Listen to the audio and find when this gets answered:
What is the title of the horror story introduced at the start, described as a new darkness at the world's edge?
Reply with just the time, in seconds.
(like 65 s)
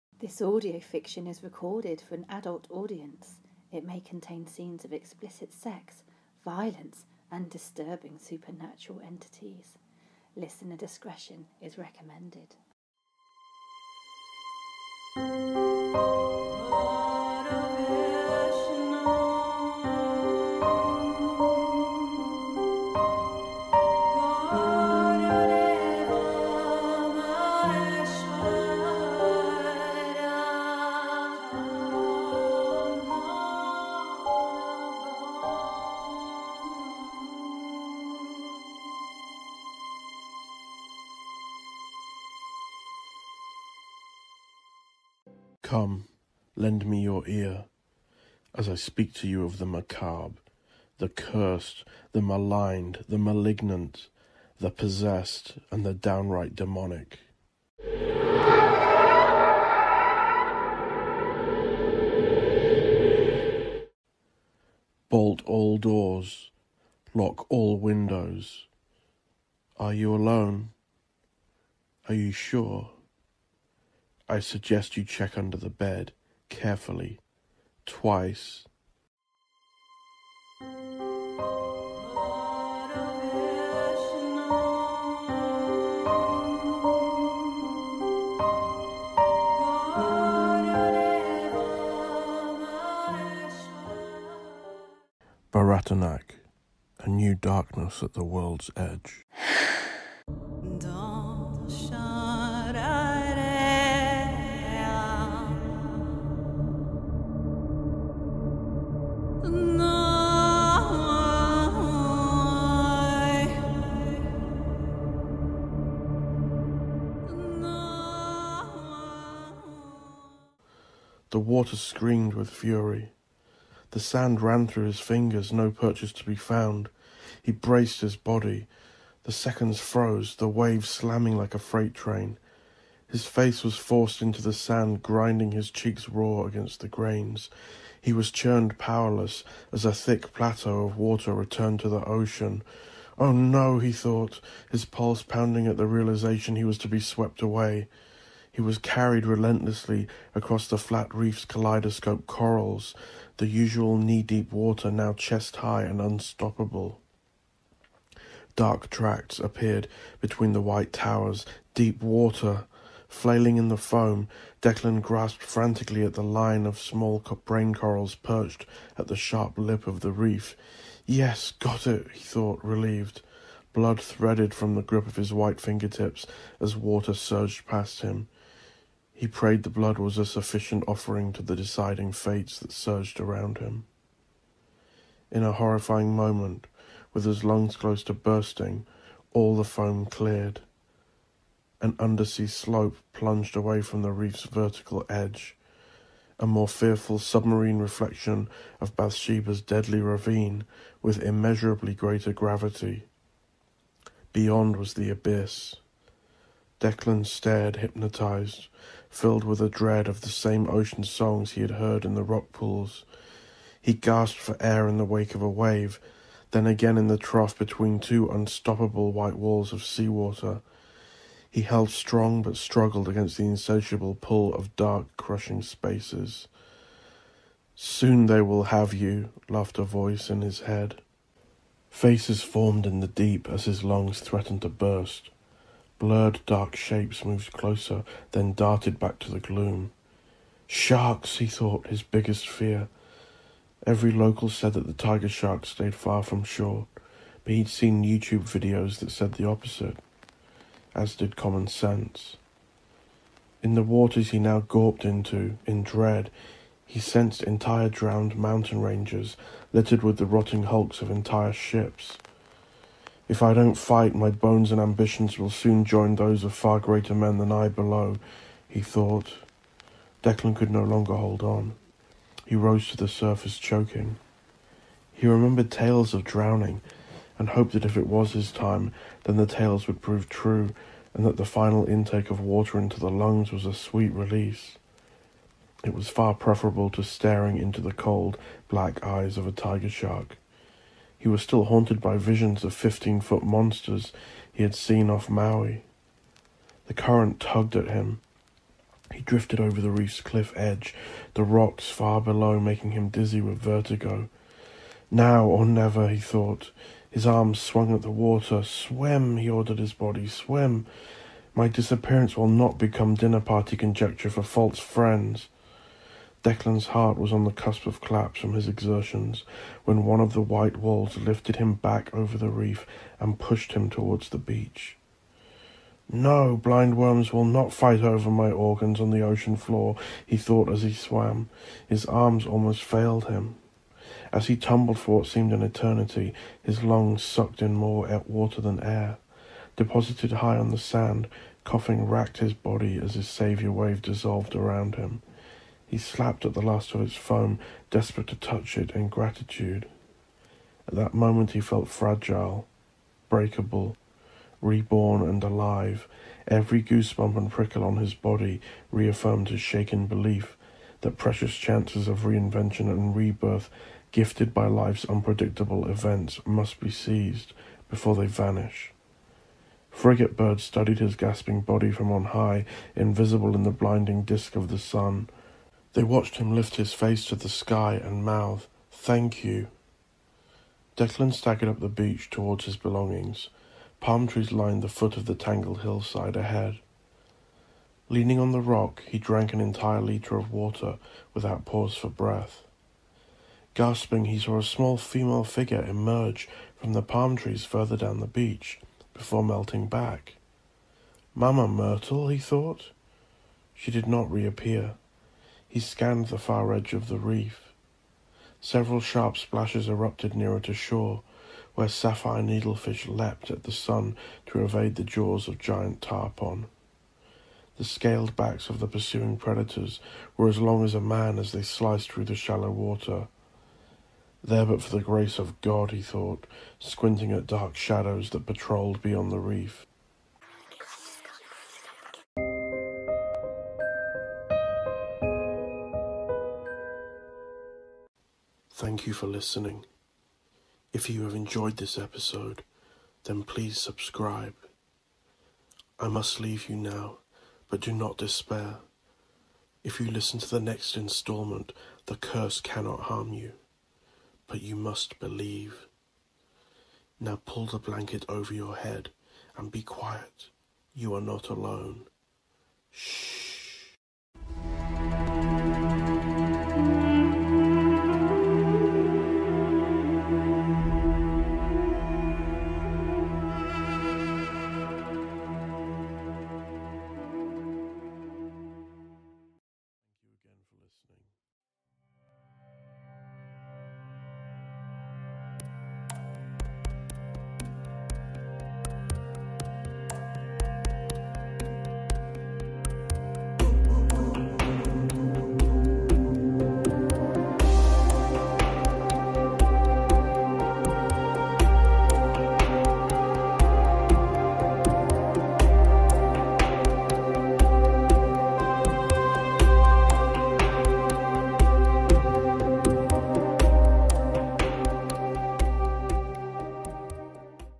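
95 s.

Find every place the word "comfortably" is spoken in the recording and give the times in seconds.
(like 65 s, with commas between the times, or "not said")
not said.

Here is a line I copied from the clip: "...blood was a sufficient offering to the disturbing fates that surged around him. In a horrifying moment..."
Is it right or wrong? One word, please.
wrong.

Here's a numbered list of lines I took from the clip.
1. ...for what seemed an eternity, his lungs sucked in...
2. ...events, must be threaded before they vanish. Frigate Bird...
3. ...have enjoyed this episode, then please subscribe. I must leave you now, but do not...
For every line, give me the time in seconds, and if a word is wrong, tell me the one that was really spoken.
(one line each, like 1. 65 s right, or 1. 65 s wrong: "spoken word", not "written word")
1. 334 s right
2. 365 s wrong: "seized", not "threaded"
3. 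441 s right.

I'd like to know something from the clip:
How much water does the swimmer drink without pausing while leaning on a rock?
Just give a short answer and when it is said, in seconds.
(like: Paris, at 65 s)
1 litre, at 389 s.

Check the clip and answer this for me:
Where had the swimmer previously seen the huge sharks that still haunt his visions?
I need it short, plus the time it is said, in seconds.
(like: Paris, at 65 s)
Maui, at 295 s.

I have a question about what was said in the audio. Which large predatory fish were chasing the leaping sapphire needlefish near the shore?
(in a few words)
Giant tarpon.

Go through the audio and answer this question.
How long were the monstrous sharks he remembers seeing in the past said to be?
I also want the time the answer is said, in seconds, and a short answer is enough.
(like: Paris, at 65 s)
15 feet, at 292 s.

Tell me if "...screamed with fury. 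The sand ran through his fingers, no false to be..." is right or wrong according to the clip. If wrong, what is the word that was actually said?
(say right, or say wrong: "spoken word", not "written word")
wrong: "purchase", not "false".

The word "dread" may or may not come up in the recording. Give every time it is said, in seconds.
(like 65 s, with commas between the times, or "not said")
209 s, 255 s.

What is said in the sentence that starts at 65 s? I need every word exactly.
Bolt all doors, lock all windows.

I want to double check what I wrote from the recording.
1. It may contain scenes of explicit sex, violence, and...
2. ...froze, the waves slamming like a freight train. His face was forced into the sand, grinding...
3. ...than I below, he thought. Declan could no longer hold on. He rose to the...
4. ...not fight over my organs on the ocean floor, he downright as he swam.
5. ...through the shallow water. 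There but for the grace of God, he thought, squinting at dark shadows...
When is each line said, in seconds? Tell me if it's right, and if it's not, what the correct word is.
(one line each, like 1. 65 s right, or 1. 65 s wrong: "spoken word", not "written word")
1. 3 s right
2. 129 s right
3. 267 s right
4. 327 s wrong: "thought", not "downright"
5. 422 s right.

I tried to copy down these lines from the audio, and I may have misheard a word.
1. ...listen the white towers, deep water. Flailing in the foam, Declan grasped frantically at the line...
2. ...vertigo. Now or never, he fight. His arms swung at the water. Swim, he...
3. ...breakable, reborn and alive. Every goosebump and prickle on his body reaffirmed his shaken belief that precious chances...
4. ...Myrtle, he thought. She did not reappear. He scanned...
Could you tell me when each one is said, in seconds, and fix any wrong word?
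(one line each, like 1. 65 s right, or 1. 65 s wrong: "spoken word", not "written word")
1. 160 s wrong: "between", not "listen"
2. 303 s wrong: "thought", not "fight"
3. 353 s right
4. 401 s right.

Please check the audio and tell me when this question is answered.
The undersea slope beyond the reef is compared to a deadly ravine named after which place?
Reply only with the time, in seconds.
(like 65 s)
198 s.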